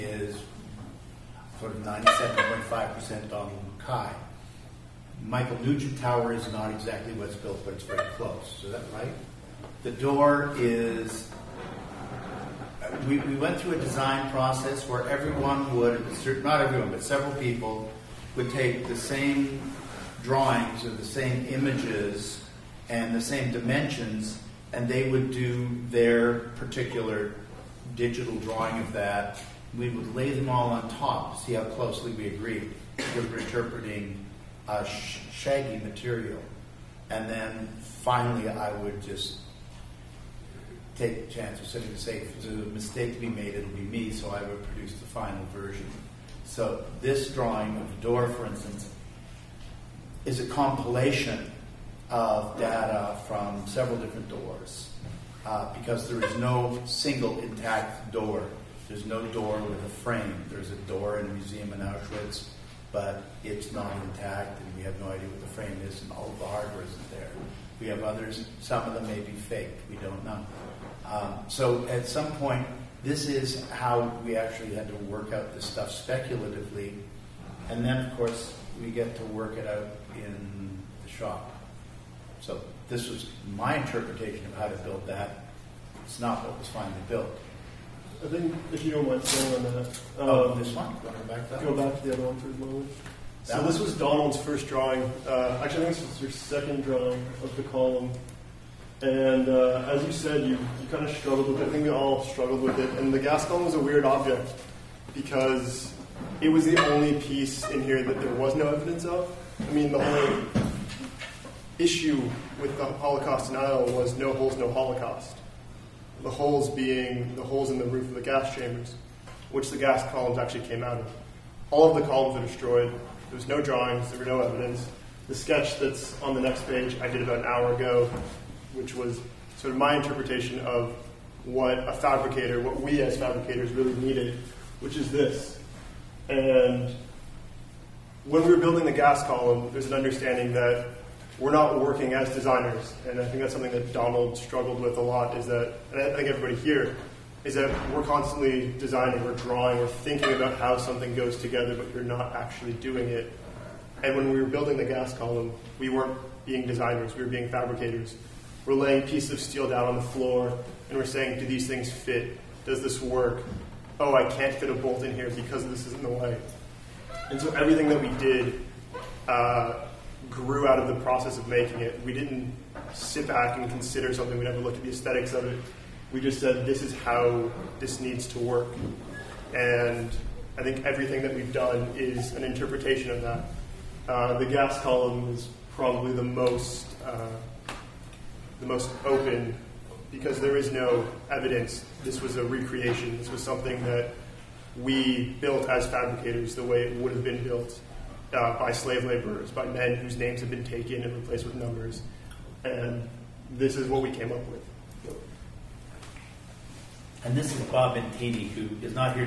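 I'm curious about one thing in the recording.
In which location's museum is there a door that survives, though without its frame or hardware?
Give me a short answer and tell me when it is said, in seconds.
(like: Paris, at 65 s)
Auschwitz, at 61 s.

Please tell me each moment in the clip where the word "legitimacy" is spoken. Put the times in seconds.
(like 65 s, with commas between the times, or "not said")
not said.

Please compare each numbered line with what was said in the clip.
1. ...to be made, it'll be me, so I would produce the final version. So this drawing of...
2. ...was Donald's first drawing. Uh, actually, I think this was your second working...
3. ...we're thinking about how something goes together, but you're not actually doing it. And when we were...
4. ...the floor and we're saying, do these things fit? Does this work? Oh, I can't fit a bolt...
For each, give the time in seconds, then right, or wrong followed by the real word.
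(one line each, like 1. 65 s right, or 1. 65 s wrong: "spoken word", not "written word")
1. 43 s right
2. 93 s wrong: "drawing", not "working"
3. 149 s right
4. 159 s right.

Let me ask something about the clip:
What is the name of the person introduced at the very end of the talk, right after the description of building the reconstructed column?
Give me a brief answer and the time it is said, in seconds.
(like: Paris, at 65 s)
Bob Bentini, at 207 s.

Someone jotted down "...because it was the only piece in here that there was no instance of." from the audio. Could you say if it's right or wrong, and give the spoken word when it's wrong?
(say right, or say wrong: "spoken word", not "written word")
wrong: "evidence", not "instance".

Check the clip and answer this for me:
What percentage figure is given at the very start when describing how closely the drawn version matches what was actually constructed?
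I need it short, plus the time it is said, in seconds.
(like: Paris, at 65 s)
97.5%, at 1 s.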